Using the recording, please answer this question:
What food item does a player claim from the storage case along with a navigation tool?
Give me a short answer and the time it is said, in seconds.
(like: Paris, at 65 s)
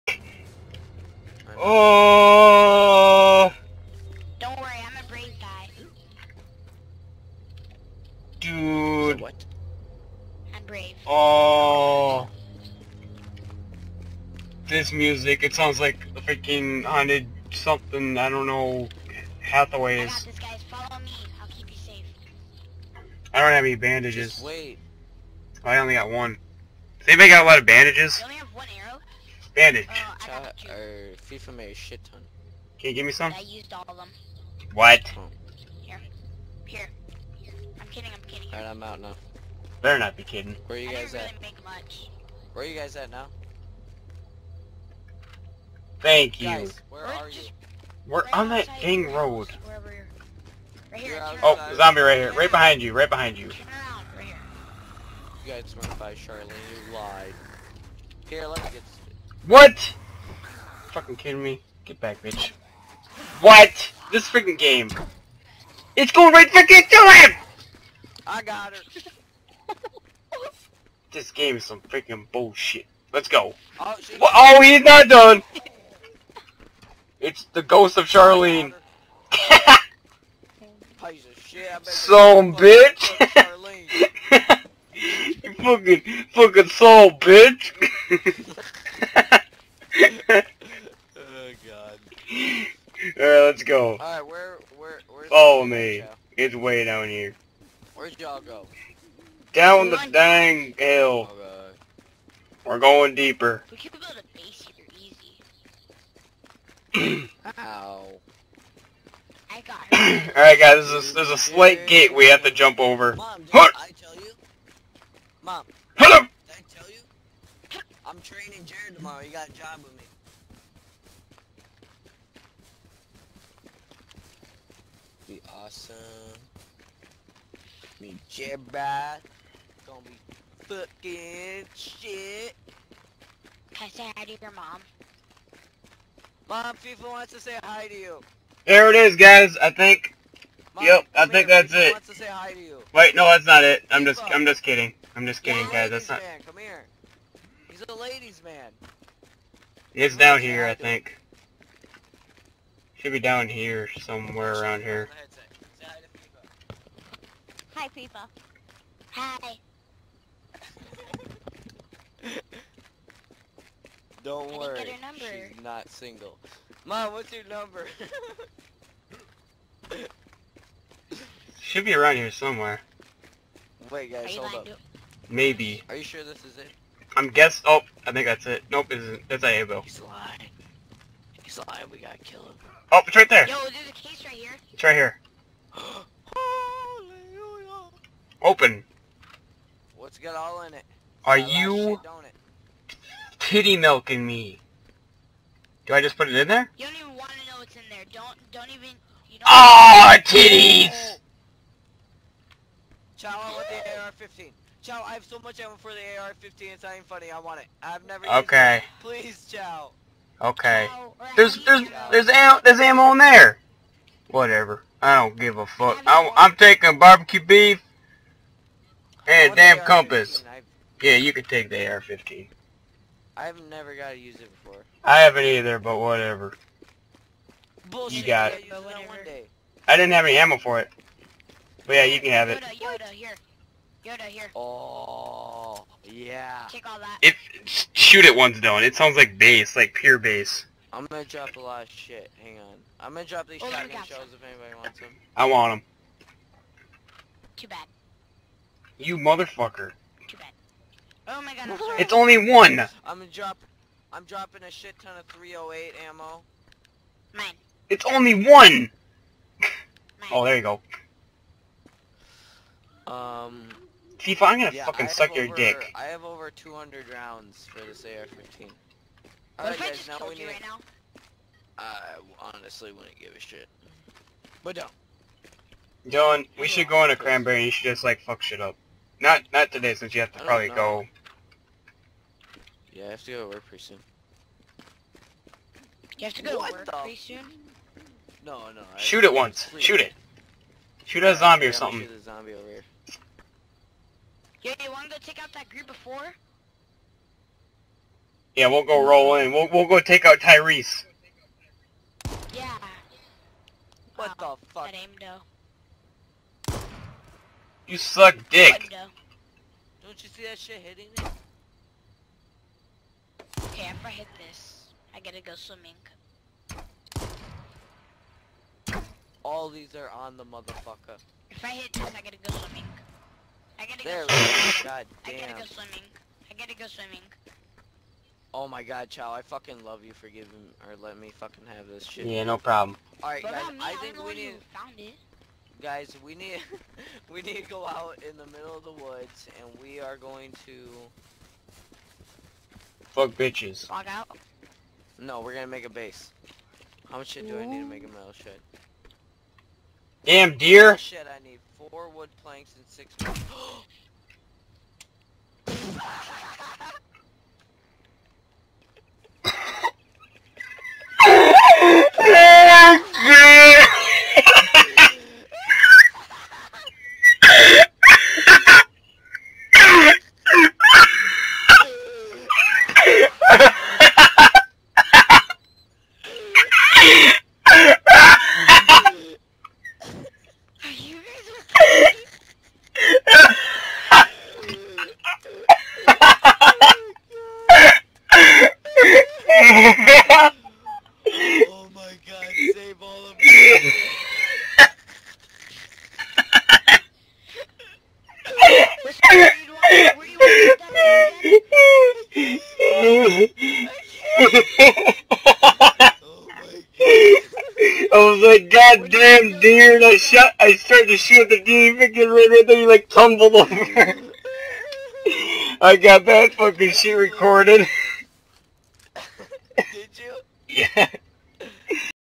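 barbecue beef, at 216 s.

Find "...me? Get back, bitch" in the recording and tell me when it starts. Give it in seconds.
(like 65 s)
61 s.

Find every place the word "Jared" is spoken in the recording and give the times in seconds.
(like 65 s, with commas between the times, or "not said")
118 s, 128 s.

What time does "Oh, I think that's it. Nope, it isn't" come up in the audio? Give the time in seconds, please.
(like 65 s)
177 s.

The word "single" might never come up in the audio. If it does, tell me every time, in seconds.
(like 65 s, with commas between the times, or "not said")
165 s.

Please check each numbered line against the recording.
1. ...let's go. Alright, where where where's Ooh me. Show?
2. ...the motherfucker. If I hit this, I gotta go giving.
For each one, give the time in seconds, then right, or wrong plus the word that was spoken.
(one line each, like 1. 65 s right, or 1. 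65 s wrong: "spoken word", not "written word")
1. 93 s wrong: "Follow", not "Ooh"
2. 320 s wrong: "swimming", not "giving".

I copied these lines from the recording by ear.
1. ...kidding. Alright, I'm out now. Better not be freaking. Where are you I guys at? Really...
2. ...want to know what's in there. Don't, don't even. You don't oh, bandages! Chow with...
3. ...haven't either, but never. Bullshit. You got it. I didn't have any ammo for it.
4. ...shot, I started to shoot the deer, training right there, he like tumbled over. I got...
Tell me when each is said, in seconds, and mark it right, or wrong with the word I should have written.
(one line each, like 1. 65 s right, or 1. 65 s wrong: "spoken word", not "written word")
1. 38 s wrong: "kidding", not "freaking"
2. 197 s wrong: "titties", not "bandages"
3. 225 s wrong: "whatever", not "never"
4. 410 s wrong: "freaking", not "training".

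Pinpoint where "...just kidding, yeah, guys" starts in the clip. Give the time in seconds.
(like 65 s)
145 s.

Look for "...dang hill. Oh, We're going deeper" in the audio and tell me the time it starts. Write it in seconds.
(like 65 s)
100 s.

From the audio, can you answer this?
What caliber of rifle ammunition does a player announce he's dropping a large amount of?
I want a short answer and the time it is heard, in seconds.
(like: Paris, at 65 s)
308, at 255 s.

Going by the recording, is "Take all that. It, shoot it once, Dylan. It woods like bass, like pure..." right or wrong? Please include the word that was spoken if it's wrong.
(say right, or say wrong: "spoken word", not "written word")
wrong: "sounds", not "woods".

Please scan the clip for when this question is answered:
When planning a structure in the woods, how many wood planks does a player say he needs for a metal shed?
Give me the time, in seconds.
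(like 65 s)
351 s.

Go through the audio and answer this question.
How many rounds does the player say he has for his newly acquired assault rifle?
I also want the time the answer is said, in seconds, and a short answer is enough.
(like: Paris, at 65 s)
over 200, at 266 s.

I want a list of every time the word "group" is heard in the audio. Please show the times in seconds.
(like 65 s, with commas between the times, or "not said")
295 s.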